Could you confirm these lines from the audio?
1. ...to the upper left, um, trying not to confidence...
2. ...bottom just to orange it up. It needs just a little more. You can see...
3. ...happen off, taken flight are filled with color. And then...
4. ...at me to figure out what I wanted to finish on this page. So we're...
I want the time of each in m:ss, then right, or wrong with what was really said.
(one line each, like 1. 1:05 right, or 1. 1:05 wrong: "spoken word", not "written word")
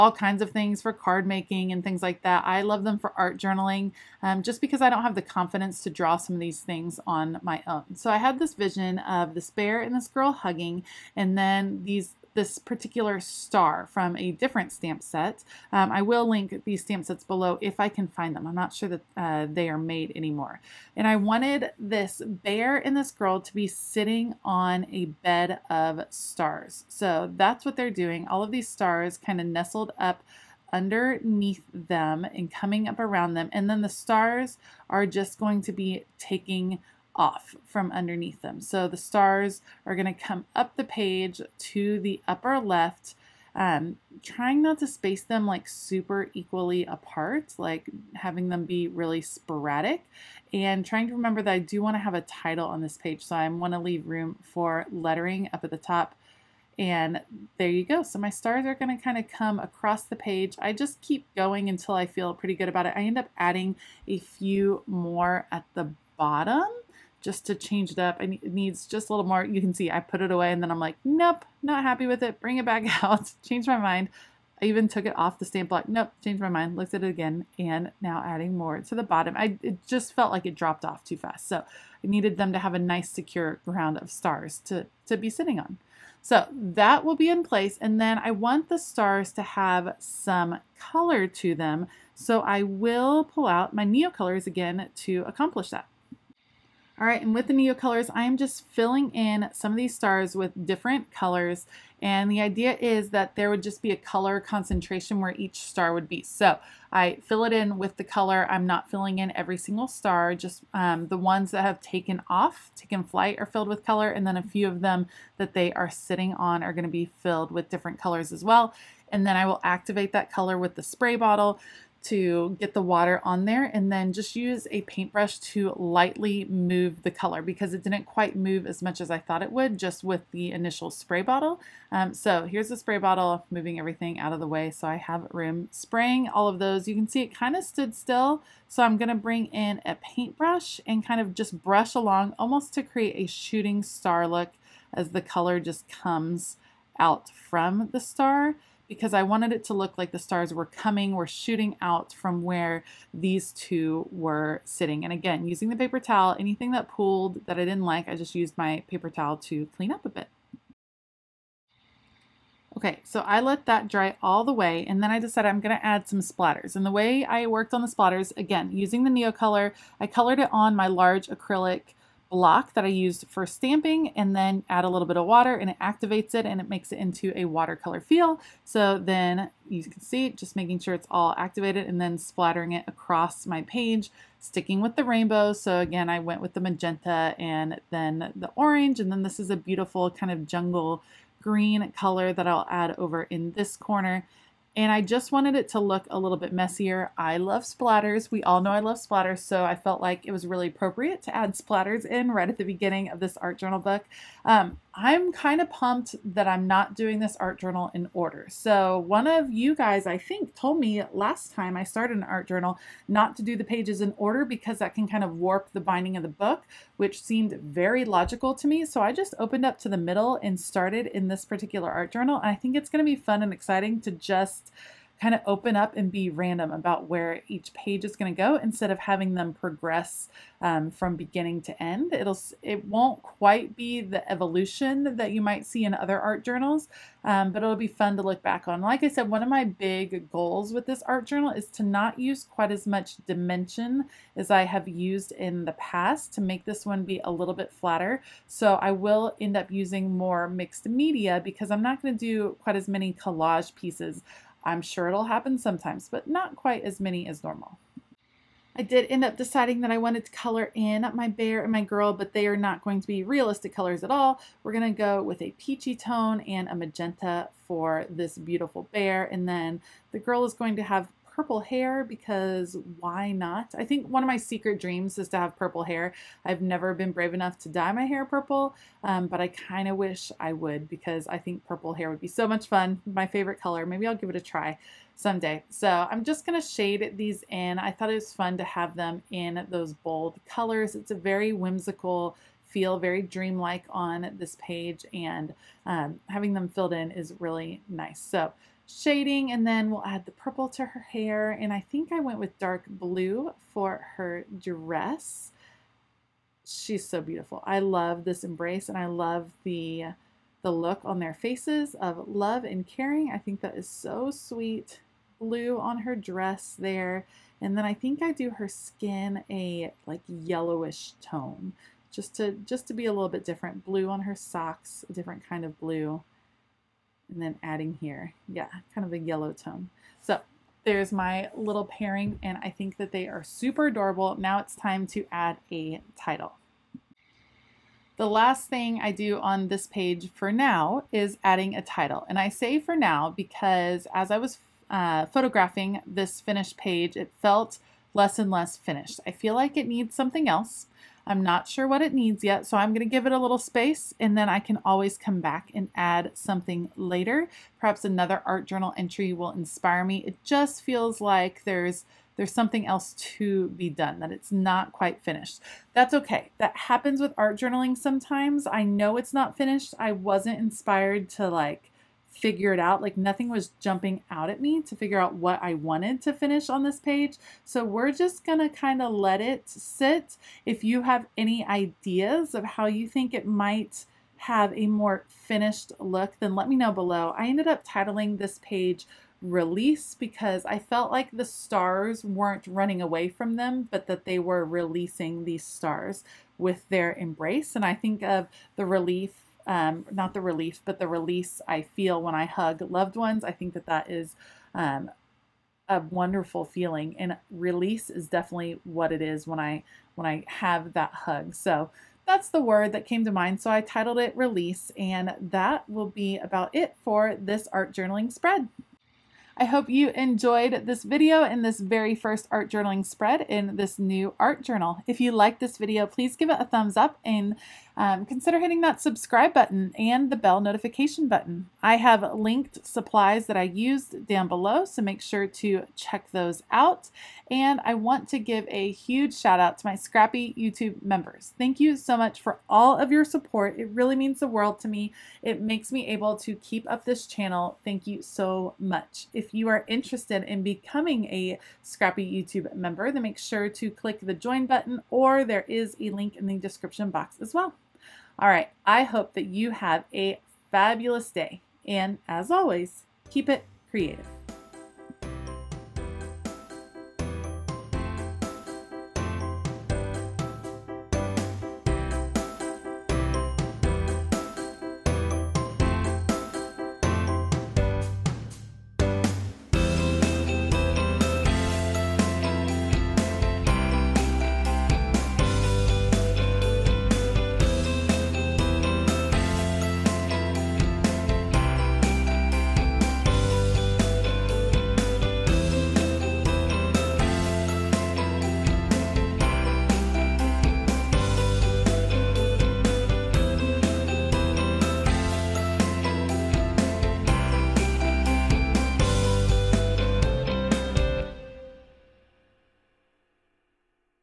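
1. 0:41 wrong: "space", not "confidence"
2. 1:06 wrong: "change", not "orange"
3. 1:51 wrong: "taken", not "happen"
4. 6:14 right.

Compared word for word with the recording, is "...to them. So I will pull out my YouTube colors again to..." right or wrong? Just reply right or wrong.
wrong.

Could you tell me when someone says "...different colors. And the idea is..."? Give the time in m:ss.
1:40.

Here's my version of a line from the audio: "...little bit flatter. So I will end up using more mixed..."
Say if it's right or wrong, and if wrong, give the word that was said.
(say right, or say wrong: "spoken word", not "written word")
right.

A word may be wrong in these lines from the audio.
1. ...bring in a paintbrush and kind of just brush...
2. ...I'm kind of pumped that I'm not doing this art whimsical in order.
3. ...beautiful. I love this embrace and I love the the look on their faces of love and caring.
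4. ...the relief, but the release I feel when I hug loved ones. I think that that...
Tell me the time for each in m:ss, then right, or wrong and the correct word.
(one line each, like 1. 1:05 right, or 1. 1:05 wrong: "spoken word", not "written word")
1. 2:19 right
2. 3:24 wrong: "journal", not "whimsical"
3. 5:07 right
4. 6:40 right.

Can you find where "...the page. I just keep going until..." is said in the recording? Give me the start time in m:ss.
1:00.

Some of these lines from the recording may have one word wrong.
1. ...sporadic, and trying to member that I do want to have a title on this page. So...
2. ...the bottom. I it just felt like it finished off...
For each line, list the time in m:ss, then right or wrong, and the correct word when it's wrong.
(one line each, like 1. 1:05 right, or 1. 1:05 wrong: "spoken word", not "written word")
1. 0:49 wrong: "remember", not "member"
2. 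1:18 wrong: "dropped", not "finished".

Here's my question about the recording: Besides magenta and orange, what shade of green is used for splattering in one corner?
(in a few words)
jungle green.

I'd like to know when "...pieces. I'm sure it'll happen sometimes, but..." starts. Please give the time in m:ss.
4:13.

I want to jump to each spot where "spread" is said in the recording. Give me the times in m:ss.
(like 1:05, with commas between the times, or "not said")
6:58, 7:03.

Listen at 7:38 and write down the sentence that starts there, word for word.
All right, I hope that you have a fabulous day.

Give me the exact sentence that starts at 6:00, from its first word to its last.
It just feels like there's there's something else to be done, that it's not quite finished.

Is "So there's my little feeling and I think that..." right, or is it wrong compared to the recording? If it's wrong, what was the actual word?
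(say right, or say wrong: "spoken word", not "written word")
wrong: "pairing", not "feeling".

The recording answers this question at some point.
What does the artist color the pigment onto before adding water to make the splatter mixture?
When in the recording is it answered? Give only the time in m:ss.
2:50.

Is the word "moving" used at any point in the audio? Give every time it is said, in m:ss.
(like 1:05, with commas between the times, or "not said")
2:13.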